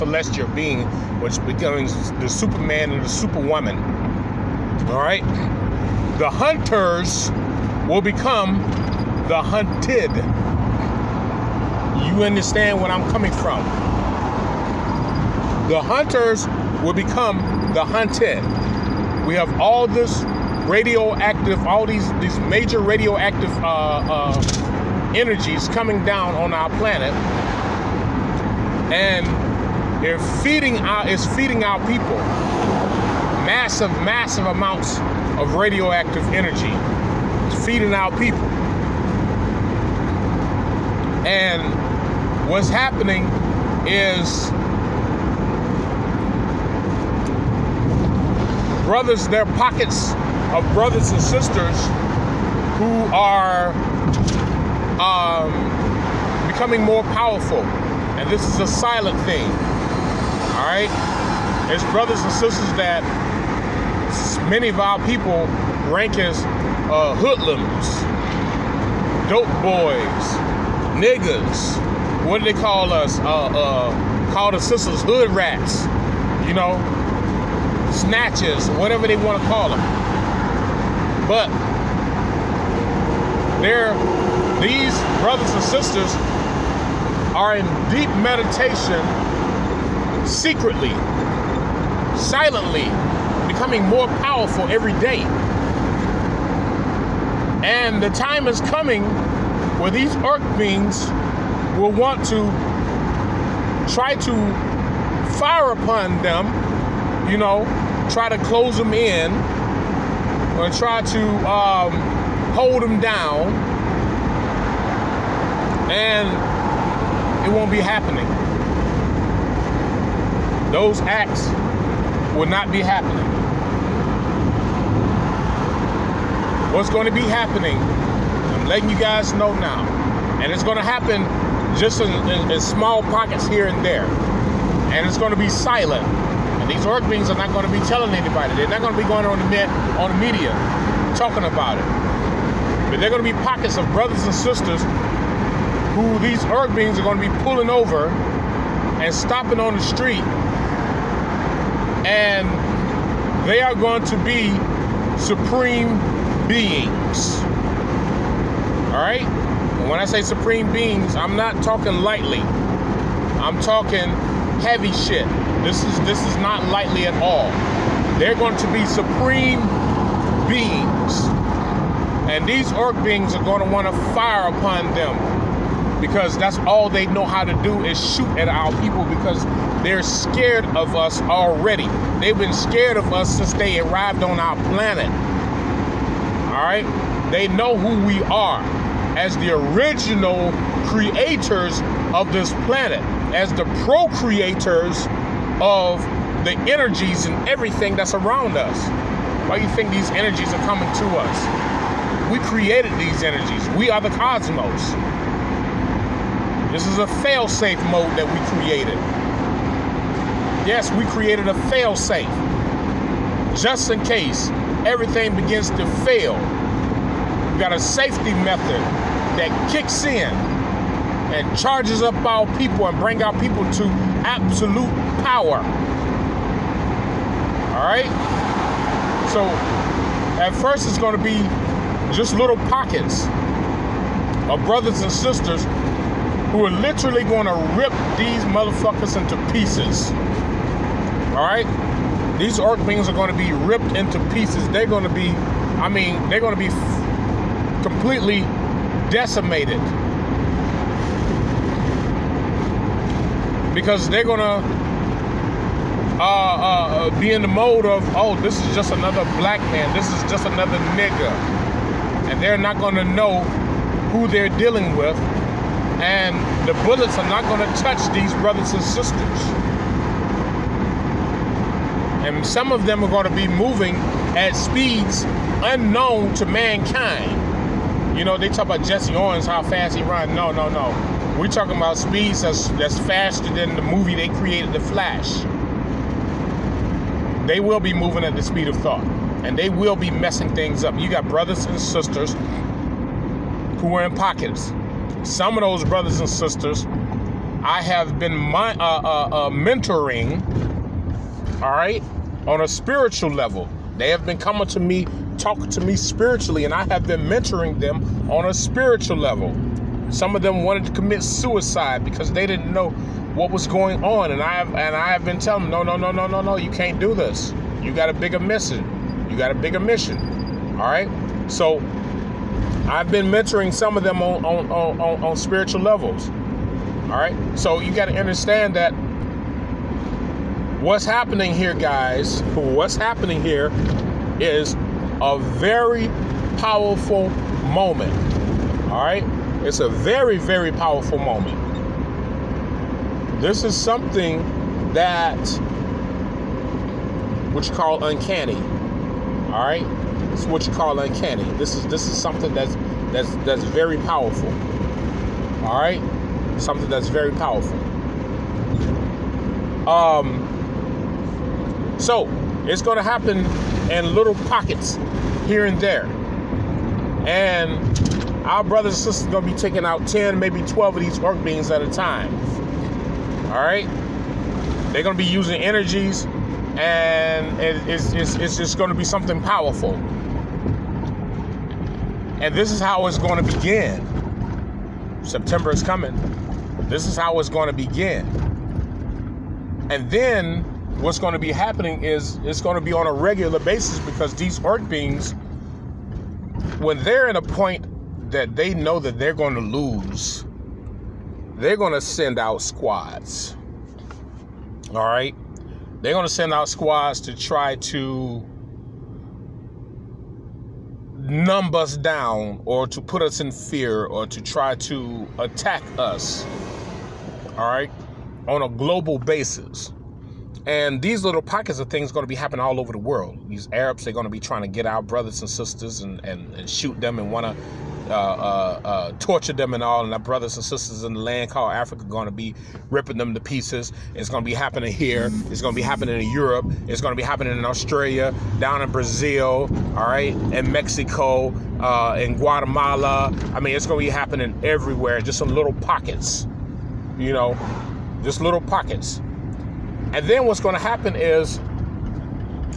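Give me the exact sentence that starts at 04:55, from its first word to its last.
Some of those brothers and sisters, I have been my, uh, uh, uh, mentoring, all right, on a spiritual level.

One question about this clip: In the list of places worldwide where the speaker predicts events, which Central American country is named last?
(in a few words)
Guatemala.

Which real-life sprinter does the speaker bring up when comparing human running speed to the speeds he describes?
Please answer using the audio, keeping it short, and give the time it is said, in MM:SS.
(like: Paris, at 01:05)
Jesse Owens, at 04:38.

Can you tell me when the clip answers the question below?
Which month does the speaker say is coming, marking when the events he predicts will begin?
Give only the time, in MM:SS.
06:25.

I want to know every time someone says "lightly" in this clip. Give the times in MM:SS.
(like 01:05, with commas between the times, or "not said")
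02:42, 02:46.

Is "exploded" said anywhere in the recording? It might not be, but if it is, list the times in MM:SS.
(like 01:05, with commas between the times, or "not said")
not said.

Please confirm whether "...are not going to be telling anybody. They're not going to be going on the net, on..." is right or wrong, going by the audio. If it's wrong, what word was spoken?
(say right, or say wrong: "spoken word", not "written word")
right.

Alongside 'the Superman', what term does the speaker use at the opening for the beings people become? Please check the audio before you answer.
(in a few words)
Superwoman.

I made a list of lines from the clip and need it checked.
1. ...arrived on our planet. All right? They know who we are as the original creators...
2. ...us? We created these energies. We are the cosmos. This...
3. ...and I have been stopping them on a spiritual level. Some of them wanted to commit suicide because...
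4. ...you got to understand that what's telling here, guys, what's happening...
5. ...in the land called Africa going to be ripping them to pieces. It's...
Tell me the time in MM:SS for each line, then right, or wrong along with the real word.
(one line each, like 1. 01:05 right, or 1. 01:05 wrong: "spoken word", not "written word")
1. 03:03 right
2. 03:21 right
3. 05:06 wrong: "mentoring", not "stopping"
4. 05:27 wrong: "happening", not "telling"
5. 07:11 right.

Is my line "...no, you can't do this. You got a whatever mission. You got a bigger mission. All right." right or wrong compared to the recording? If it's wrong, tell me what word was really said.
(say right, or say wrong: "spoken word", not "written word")
wrong: "bigger", not "whatever".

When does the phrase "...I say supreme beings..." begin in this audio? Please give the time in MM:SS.
02:39.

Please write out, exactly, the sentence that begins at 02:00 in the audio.
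Those acts will not be happening.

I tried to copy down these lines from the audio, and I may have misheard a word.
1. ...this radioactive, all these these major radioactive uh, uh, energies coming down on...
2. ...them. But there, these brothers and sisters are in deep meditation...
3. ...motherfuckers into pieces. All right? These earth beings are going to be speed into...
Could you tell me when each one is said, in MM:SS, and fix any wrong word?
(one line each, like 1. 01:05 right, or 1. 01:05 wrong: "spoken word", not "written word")
1. 00:19 right
2. 01:19 right
3. 03:58 wrong: "ripped", not "speed".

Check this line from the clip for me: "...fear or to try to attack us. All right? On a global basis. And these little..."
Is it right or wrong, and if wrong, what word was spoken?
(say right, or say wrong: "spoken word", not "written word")
right.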